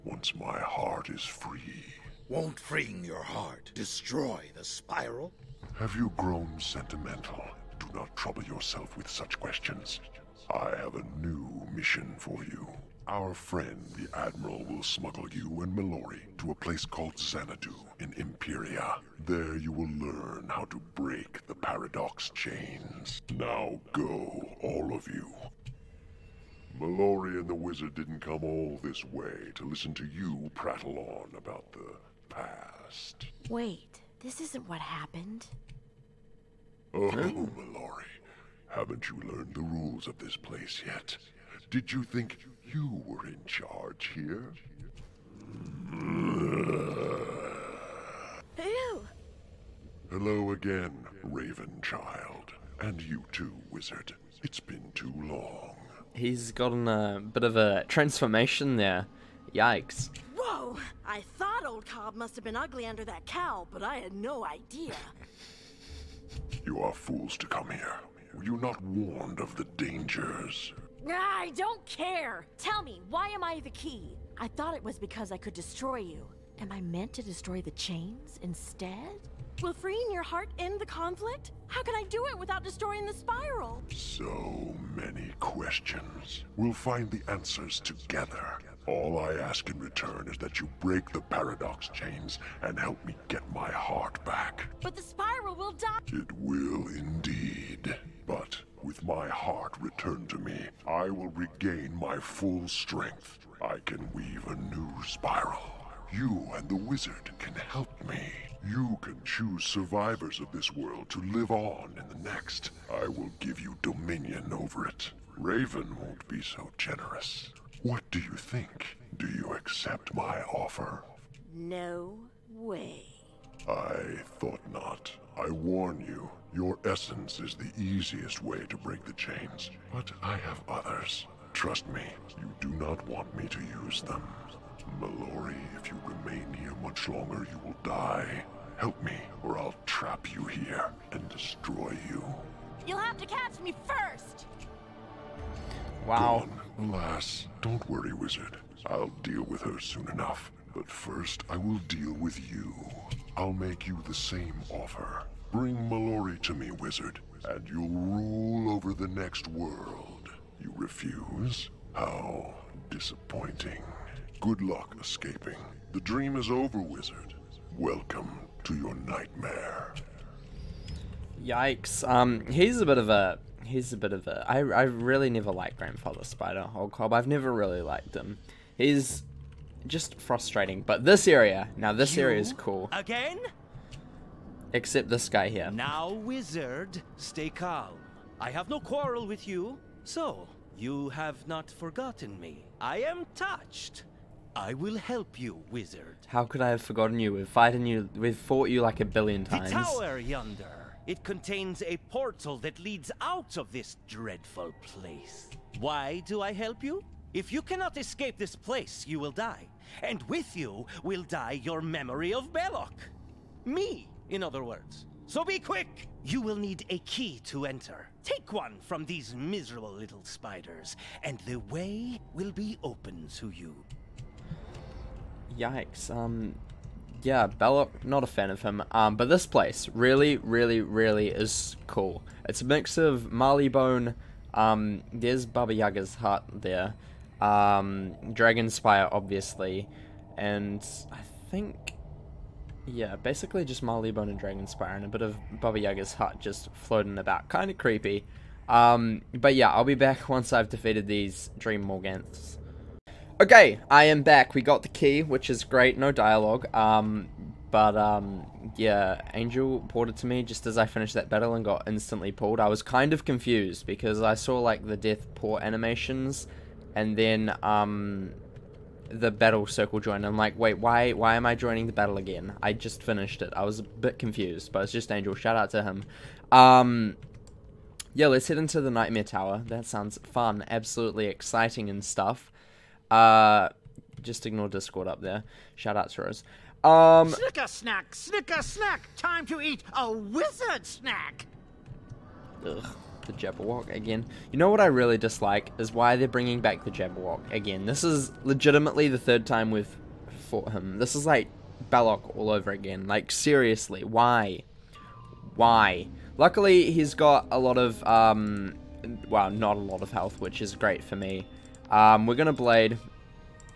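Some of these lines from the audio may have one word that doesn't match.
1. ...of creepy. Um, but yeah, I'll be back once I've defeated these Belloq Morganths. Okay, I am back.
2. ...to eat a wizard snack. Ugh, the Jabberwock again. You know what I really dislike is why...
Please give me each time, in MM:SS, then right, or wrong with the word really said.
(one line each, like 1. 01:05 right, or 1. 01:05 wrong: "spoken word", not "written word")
1. 04:07 wrong: "Dream", not "Belloq"
2. 04:49 right.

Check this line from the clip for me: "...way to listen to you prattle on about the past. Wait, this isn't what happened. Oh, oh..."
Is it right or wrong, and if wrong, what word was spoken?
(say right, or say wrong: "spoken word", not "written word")
right.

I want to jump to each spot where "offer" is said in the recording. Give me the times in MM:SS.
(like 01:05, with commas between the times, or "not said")
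02:00, 02:34.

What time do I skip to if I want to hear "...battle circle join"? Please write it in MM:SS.
04:29.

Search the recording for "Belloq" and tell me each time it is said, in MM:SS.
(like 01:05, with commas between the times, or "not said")
03:32, 03:47, 05:01.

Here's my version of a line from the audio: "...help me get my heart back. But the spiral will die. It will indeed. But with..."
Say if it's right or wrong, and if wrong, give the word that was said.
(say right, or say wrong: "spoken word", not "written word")
right.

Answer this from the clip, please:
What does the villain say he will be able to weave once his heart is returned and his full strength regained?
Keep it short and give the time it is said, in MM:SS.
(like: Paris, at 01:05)
a new spiral, at 01:44.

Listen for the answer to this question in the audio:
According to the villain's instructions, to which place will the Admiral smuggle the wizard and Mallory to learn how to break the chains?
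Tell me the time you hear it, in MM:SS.
00:17.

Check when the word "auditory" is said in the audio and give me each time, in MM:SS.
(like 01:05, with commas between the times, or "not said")
not said.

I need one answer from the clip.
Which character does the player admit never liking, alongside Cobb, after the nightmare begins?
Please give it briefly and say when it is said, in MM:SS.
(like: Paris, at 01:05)
Grandfather Spider, at 02:55.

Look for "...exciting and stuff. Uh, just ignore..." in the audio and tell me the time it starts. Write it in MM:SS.
04:41.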